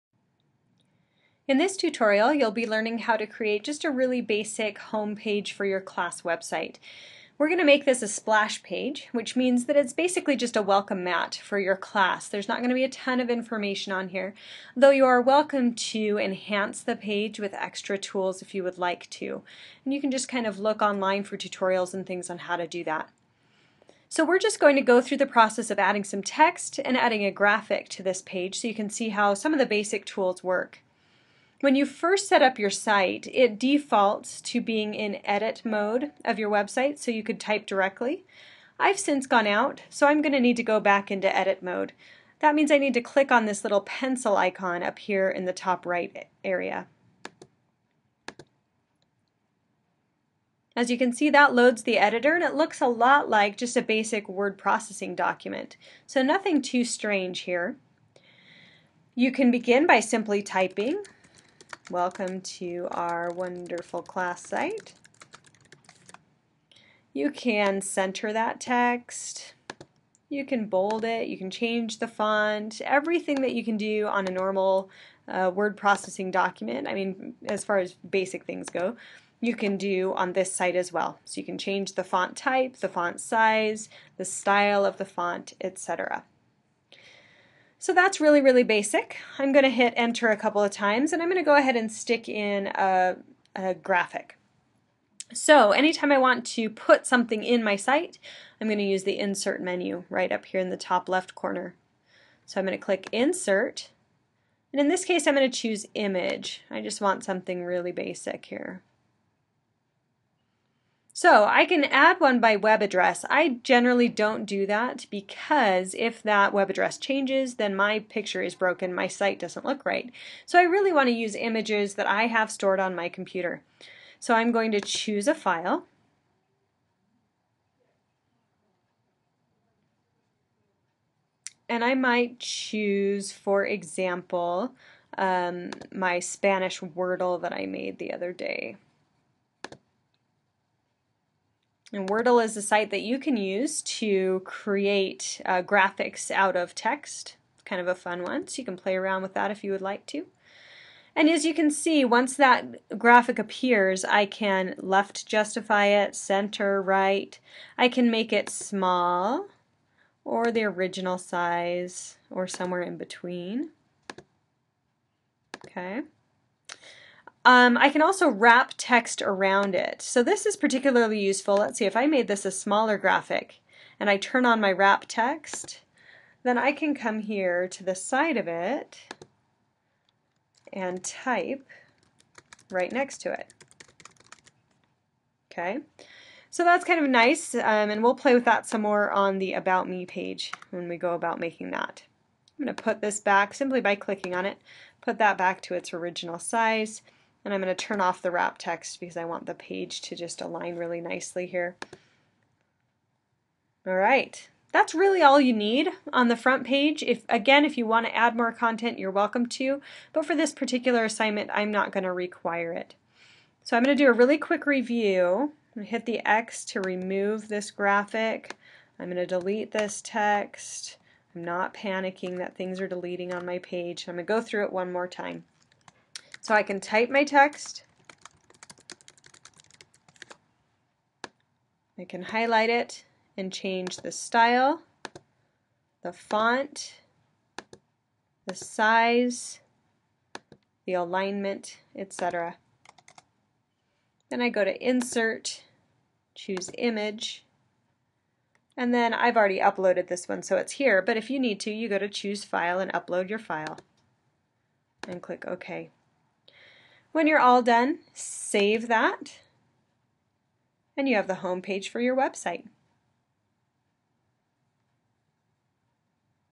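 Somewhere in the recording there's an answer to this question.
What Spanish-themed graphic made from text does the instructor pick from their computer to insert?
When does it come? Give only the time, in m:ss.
2:16.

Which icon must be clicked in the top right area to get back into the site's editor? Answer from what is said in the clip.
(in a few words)
pencil icon.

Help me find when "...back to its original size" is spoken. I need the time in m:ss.
3:15.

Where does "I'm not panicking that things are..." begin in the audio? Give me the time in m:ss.
3:41.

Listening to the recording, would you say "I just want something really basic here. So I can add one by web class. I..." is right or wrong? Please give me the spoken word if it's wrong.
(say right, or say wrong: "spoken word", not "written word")
wrong: "address", not "class".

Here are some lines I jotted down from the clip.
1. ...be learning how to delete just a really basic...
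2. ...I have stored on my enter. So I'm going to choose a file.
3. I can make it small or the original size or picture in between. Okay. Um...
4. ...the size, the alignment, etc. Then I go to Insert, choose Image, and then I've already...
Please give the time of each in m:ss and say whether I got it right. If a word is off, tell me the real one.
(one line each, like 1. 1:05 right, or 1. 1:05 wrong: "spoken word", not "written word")
1. 0:02 wrong: "create", not "delete"
2. 2:02 wrong: "computer", not "enter"
3. 2:37 wrong: "somewhere", not "picture"
4. 3:58 right.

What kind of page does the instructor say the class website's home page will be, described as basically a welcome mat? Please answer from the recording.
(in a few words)
splash page.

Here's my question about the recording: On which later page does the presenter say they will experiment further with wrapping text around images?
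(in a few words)
About Me page.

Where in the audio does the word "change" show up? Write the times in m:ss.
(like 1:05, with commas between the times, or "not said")
1:11, 1:21, 1:56, 3:53.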